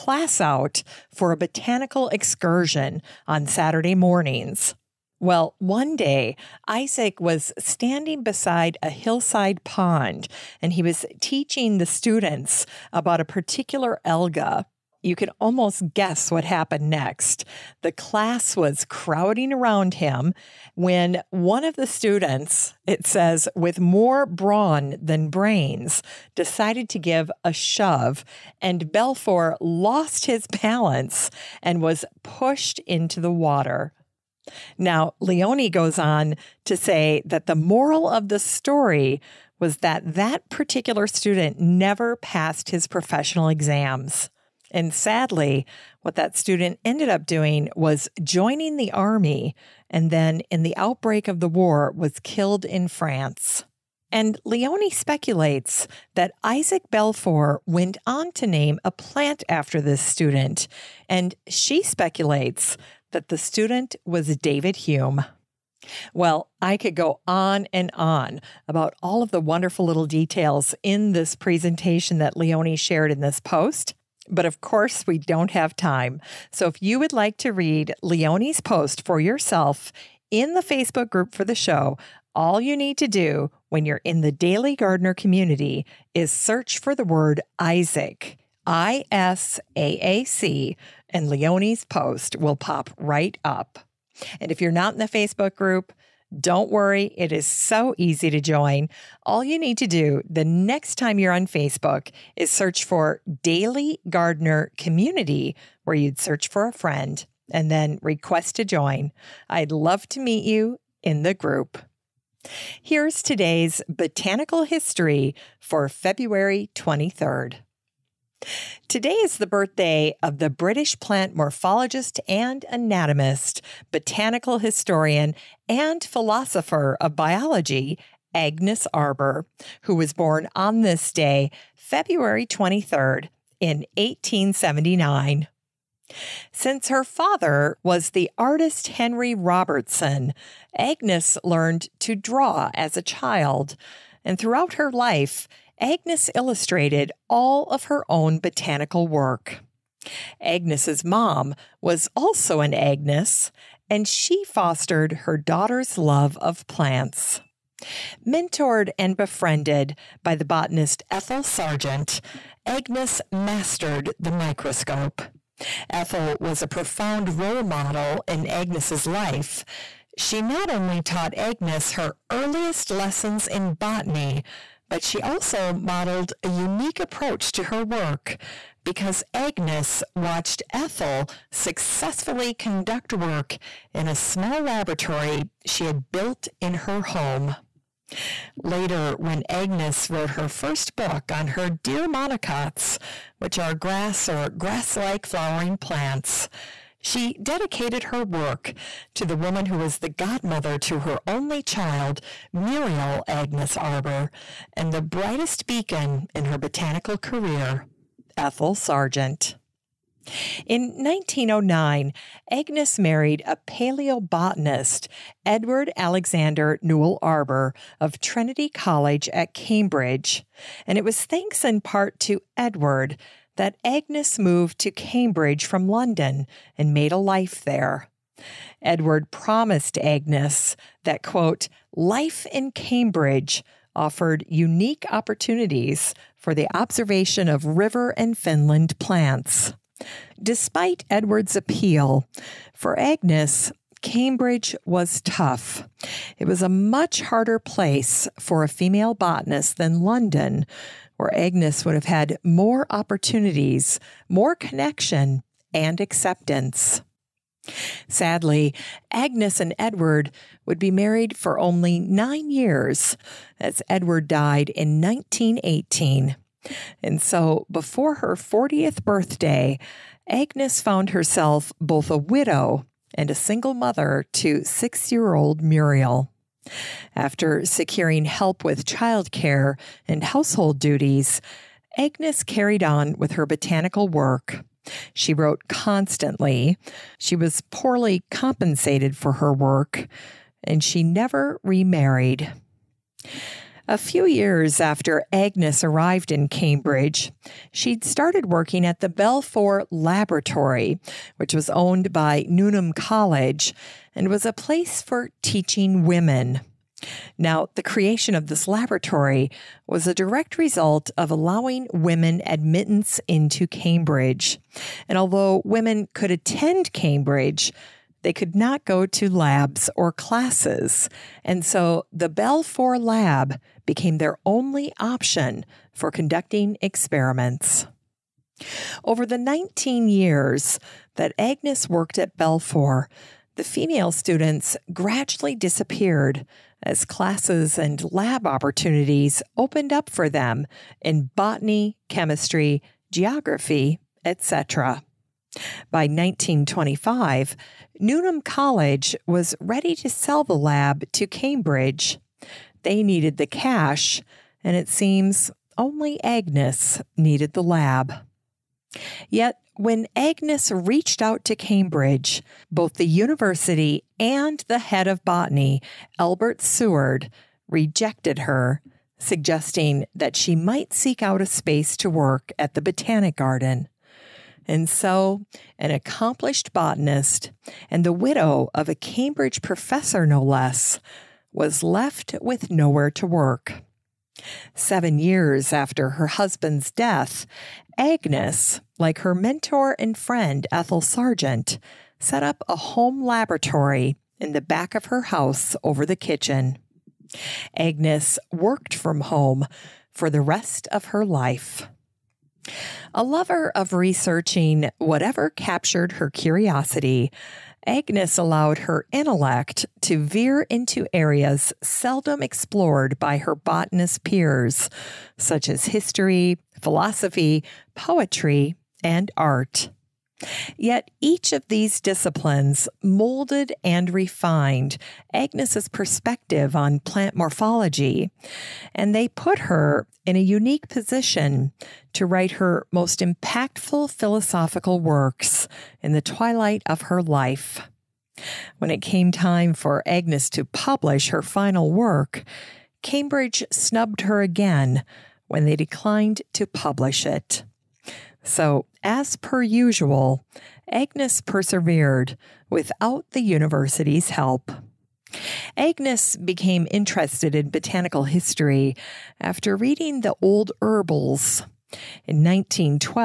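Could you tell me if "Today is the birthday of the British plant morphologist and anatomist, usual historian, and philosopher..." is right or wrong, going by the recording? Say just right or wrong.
wrong.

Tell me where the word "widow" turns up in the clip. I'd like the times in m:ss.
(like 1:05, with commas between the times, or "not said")
4:32, 6:18.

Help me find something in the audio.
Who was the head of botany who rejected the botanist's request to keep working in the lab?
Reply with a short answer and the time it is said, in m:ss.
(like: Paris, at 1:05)
Albert Seward, at 6:06.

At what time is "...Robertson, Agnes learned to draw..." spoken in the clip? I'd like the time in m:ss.
2:19.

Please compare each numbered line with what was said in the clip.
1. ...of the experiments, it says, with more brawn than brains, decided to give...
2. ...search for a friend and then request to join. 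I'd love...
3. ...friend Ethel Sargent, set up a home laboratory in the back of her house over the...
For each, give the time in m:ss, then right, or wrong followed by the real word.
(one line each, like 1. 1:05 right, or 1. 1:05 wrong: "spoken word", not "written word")
1. 0:21 wrong: "students", not "experiments"
2. 1:46 right
3. 6:30 right.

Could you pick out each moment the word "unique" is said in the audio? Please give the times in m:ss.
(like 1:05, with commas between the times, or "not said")
2:56, 3:54, 7:10.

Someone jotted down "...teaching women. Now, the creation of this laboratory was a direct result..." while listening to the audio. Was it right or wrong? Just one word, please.
right.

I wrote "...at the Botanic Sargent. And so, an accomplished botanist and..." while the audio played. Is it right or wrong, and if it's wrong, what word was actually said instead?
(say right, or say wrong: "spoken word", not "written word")
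wrong: "Garden", not "Sargent".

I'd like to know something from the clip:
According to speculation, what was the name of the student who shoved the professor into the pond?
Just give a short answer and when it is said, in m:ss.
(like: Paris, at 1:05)
David Hume, at 1:04.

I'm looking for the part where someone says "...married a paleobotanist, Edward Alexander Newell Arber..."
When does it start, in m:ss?
3:32.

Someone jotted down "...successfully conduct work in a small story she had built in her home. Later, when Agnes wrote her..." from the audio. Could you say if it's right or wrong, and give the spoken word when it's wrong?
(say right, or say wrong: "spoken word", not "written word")
wrong: "laboratory", not "story".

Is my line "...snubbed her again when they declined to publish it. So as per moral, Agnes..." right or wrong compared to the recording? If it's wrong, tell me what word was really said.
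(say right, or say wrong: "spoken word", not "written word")
wrong: "usual", not "moral".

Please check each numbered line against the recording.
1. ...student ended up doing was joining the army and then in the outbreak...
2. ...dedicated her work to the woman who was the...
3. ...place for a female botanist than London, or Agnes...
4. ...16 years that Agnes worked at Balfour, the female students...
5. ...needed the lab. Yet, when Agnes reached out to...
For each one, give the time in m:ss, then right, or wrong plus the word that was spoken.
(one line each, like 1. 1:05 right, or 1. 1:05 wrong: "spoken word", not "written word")
1. 0:46 right
2. 3:17 right
3. 4:07 right
4. 5:29 wrong: "19", not "16"
5. 5:57 right.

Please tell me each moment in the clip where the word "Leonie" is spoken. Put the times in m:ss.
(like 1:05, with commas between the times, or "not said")
0:35, 0:54, 1:12, 1:18, 1:31.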